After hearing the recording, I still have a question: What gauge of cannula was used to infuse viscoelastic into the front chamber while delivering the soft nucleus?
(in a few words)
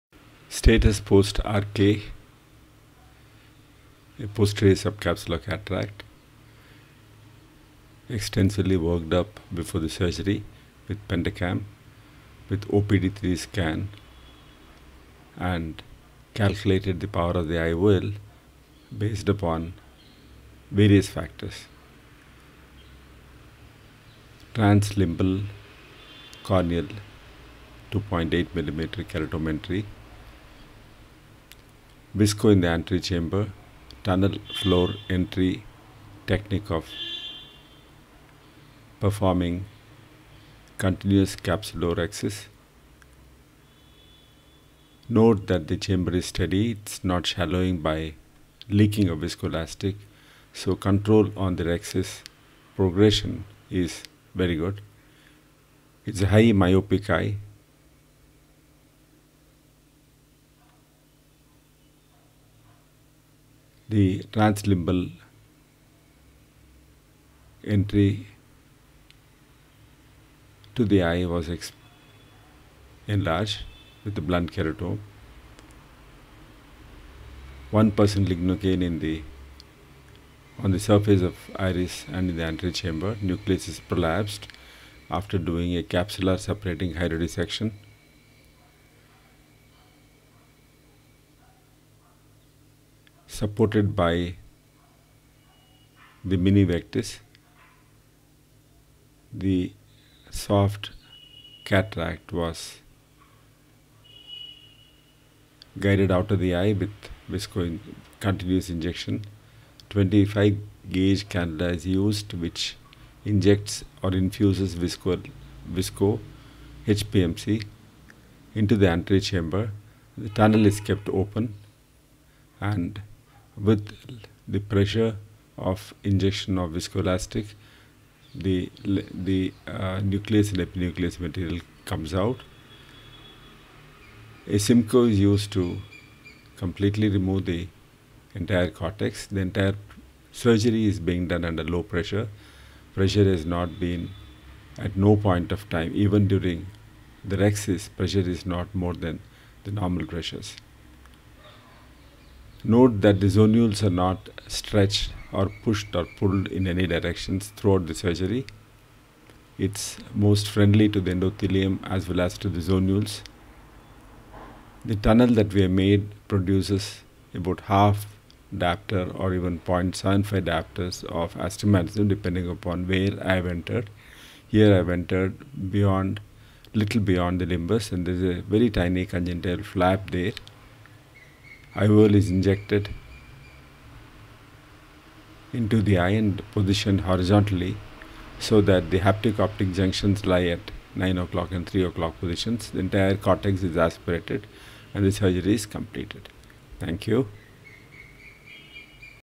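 25 gauge.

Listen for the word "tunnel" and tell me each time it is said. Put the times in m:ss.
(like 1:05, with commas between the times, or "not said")
0:34, 2:00, 2:44.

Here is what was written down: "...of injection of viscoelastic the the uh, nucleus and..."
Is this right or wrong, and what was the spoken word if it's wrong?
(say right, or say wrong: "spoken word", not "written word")
right.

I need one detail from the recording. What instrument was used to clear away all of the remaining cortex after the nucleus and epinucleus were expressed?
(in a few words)
Simcoe.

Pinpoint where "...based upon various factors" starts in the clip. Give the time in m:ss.
0:19.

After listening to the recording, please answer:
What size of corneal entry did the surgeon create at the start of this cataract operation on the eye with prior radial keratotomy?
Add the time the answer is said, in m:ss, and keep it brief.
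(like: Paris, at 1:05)
2.8 millimeter, at 0:27.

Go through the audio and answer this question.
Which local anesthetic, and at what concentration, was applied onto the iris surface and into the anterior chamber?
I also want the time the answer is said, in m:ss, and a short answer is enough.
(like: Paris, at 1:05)
1% lignocaine, at 1:17.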